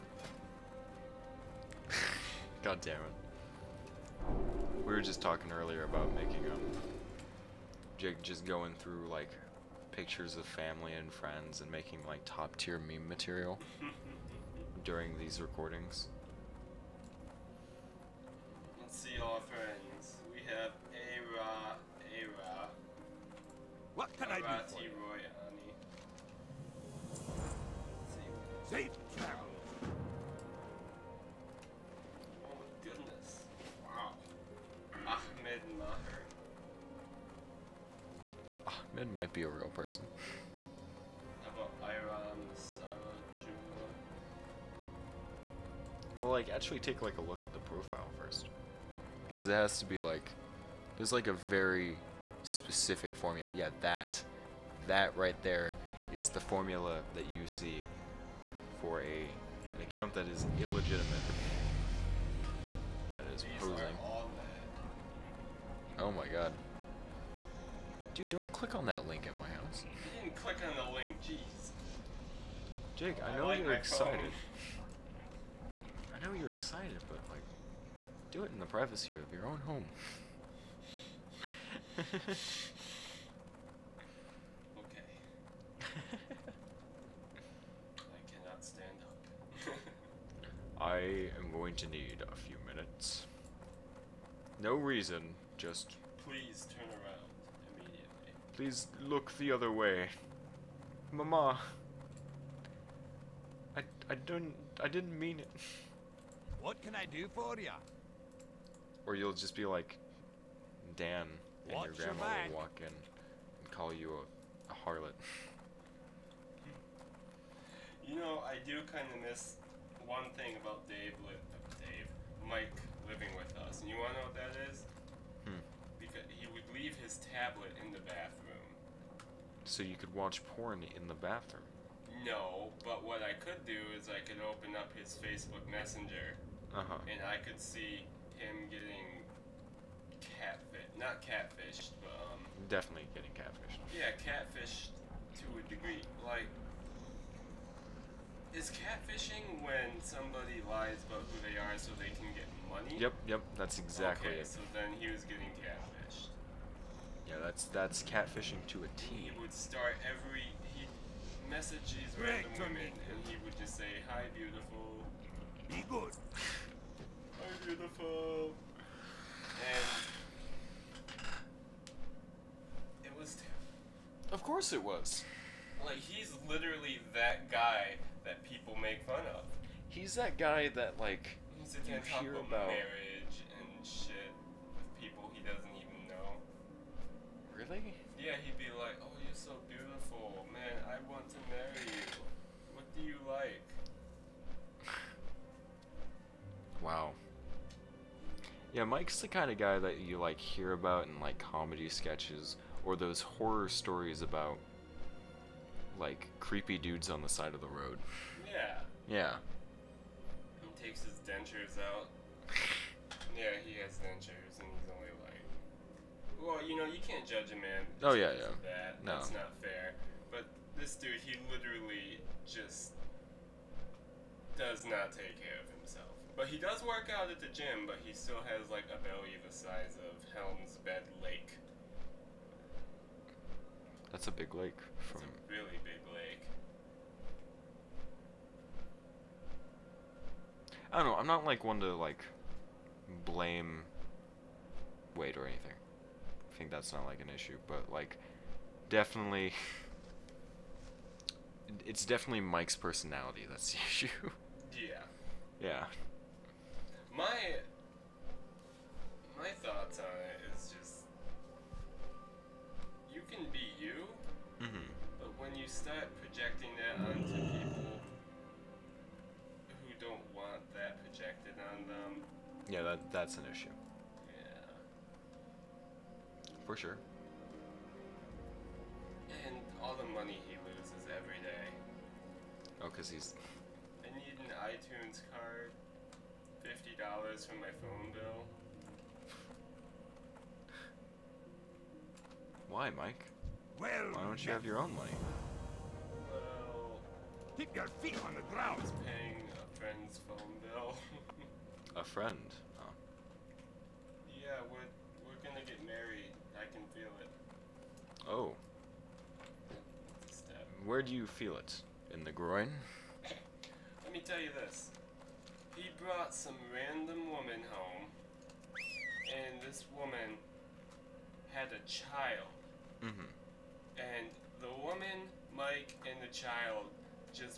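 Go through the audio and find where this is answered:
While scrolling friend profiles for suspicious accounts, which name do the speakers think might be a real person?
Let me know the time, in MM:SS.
00:35.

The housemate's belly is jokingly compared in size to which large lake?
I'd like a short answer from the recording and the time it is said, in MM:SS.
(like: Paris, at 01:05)
Helm's Bed Lake, at 03:50.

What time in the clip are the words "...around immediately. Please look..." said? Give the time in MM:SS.
01:36.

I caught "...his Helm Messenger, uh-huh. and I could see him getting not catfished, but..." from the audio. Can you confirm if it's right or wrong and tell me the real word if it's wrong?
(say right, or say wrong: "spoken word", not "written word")
wrong: "Facebook", not "Helm".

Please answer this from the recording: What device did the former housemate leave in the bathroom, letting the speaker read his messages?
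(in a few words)
Tablet.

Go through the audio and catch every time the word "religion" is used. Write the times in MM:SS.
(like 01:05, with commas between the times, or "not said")
not said.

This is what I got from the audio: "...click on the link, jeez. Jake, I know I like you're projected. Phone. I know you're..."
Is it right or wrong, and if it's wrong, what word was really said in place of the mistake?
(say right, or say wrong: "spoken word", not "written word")
wrong: "excited", not "projected".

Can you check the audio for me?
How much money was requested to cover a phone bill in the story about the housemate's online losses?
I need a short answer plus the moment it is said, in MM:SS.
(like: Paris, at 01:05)
$50, at 04:46.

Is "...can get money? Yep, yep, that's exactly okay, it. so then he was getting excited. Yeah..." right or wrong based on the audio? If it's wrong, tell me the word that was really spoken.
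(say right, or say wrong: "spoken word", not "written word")
wrong: "catfished", not "excited".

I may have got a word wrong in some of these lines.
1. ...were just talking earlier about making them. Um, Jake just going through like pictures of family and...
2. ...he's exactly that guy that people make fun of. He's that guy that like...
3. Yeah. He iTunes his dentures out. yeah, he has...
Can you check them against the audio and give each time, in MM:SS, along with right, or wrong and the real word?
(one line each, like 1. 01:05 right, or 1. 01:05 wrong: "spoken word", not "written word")
1. 00:04 right
2. 02:55 wrong: "literally", not "exactly"
3. 03:29 wrong: "takes", not "iTunes".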